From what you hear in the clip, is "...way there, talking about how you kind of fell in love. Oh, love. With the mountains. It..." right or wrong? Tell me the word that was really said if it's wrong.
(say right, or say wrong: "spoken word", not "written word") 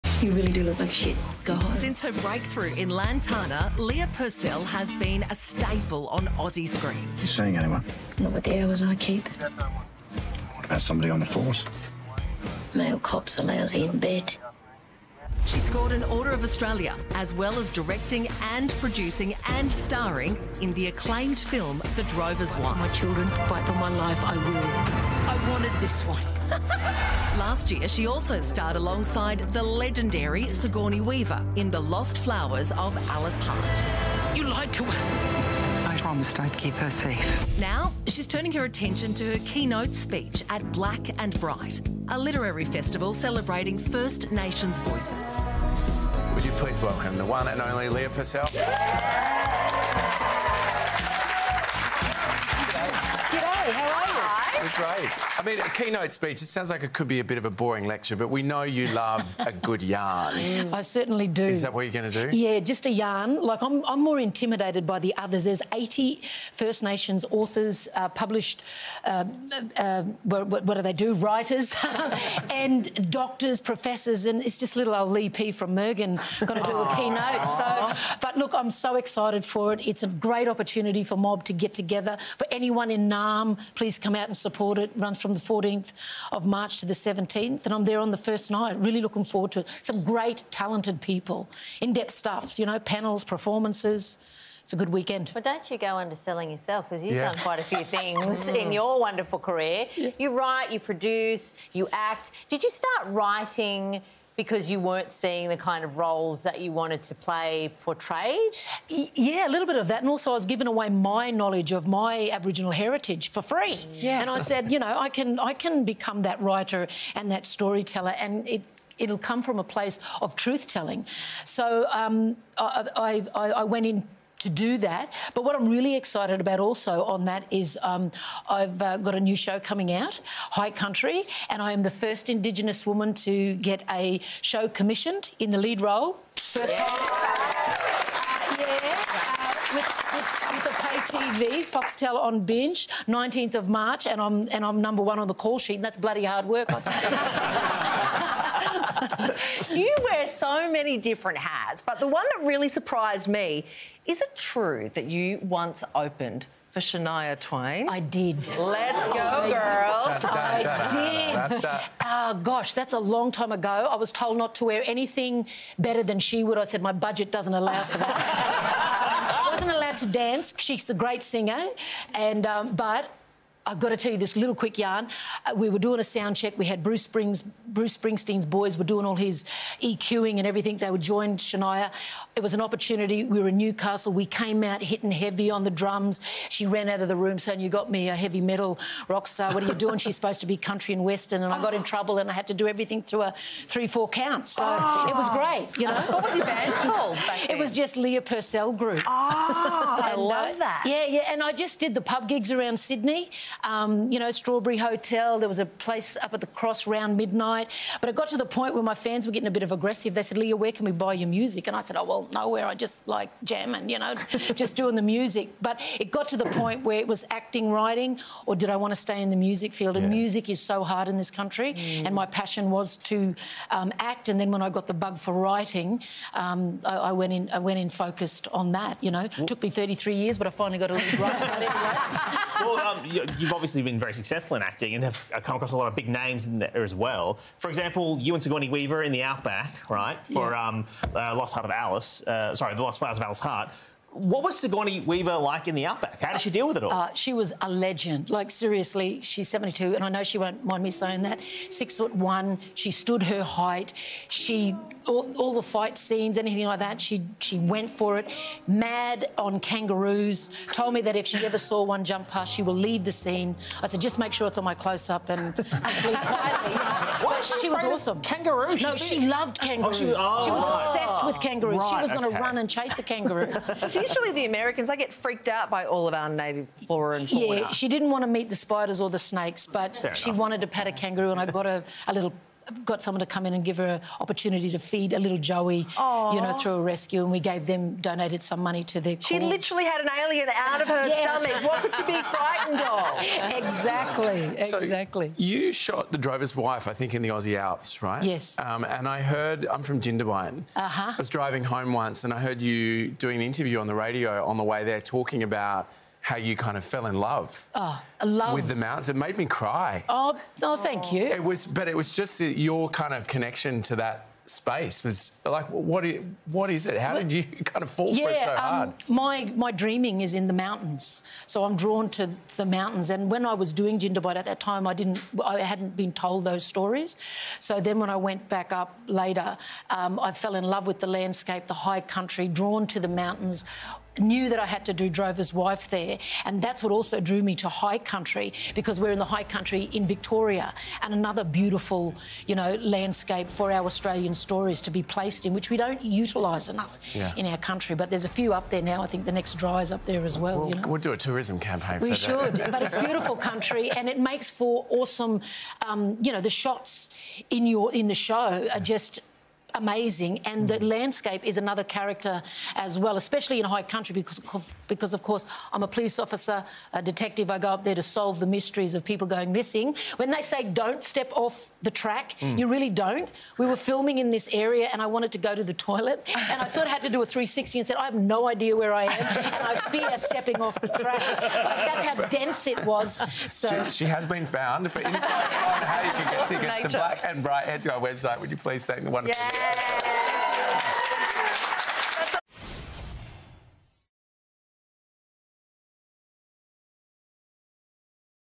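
right.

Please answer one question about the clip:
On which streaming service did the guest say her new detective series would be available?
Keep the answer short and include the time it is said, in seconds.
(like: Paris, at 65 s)
Binge, at 142 s.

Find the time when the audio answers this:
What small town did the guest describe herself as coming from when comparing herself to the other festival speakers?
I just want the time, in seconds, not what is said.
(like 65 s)
75 s.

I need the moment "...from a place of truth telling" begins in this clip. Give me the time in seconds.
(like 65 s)
119 s.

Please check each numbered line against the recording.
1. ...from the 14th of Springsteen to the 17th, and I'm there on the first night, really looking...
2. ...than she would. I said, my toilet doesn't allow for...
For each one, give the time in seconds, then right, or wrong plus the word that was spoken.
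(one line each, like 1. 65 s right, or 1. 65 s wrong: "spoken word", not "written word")
1. 85 s wrong: "March", not "Springsteen"
2. 166 s wrong: "budget", not "toilet".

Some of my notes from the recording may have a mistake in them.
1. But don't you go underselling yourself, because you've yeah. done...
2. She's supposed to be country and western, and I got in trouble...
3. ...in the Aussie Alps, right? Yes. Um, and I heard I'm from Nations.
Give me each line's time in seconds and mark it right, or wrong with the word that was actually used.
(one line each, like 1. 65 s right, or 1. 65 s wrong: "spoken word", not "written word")
1. 95 s right
2. 189 s right
3. 297 s wrong: "Jindabyne", not "Nations".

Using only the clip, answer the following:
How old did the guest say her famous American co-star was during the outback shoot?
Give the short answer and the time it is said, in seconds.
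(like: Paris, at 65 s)
72, at 249 s.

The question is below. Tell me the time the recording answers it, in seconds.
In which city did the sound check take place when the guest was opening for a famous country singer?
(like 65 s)
183 s.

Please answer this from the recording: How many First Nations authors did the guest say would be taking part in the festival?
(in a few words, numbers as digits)
80.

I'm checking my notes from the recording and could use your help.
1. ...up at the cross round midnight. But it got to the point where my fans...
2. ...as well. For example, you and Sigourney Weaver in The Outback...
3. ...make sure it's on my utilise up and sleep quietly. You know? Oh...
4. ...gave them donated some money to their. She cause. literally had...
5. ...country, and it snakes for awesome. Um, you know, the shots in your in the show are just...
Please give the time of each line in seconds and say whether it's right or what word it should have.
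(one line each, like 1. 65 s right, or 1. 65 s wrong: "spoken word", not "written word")
1. 206 s right
2. 236 s right
3. 264 s wrong: "close", not "utilise"
4. 287 s right
5. 353 s wrong: "makes", not "snakes".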